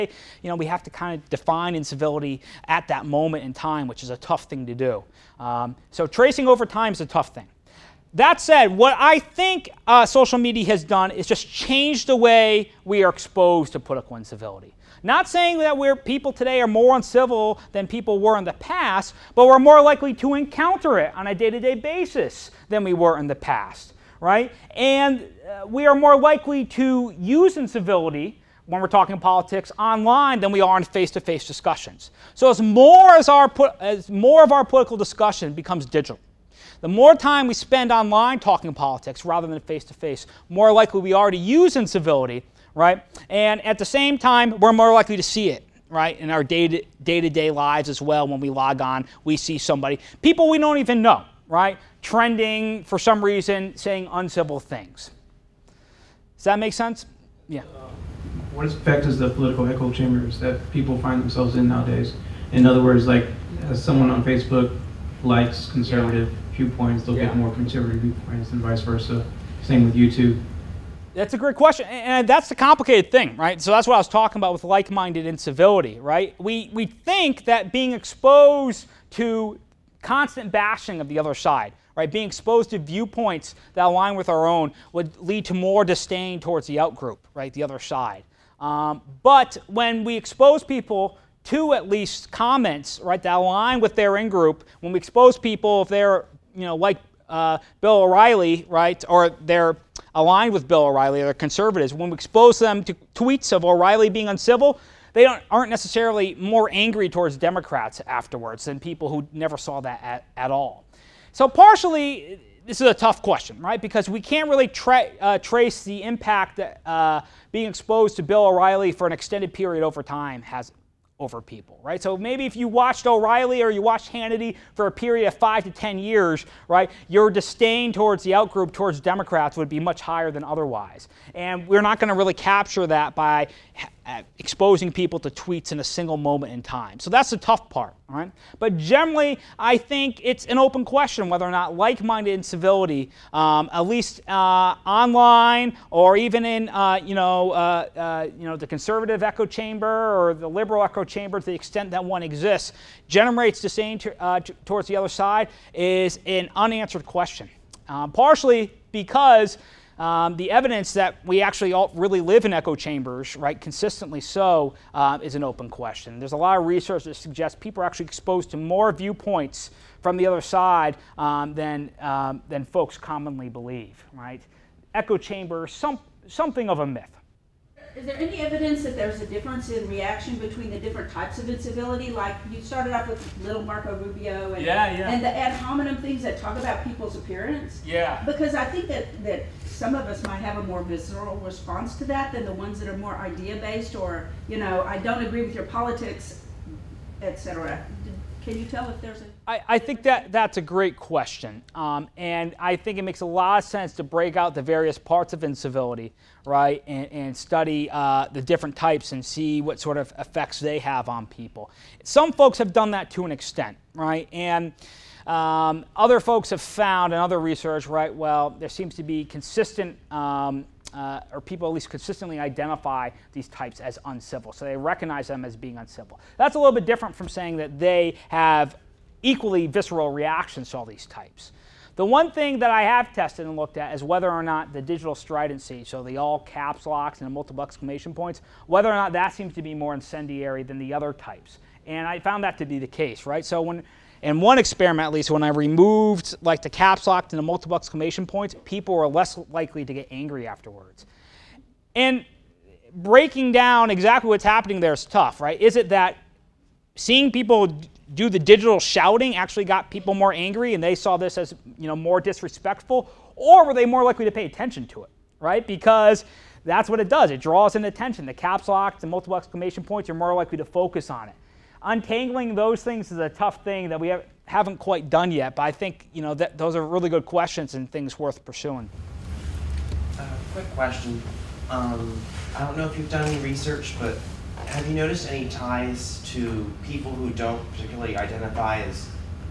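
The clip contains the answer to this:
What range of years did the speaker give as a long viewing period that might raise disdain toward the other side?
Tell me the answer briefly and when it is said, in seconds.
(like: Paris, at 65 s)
5 to 10, at 125 s.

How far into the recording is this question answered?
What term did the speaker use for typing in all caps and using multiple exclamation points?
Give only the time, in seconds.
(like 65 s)
234 s.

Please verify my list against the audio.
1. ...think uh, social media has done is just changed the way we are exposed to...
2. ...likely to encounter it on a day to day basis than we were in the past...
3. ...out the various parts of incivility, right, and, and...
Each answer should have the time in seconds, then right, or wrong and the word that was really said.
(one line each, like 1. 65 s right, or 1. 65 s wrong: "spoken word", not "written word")
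1. 9 s right
2. 19 s right
3. 204 s right.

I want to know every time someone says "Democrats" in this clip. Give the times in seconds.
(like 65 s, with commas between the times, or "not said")
107 s, 129 s.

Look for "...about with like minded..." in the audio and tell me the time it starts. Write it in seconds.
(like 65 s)
74 s.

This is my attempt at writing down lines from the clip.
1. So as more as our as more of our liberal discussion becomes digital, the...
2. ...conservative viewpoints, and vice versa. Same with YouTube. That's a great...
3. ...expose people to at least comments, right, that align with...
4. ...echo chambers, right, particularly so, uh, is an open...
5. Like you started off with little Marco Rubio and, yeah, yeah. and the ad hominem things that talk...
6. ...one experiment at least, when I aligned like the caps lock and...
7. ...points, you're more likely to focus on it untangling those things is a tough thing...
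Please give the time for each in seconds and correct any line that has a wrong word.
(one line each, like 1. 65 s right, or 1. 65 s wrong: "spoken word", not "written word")
1. 32 s wrong: "political", not "liberal"
2. 67 s right
3. 90 s right
4. 162 s wrong: "consistently", not "particularly"
5. 182 s right
6. 244 s wrong: "removed", not "aligned"
7. 269 s right.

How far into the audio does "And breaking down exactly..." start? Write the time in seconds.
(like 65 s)
251 s.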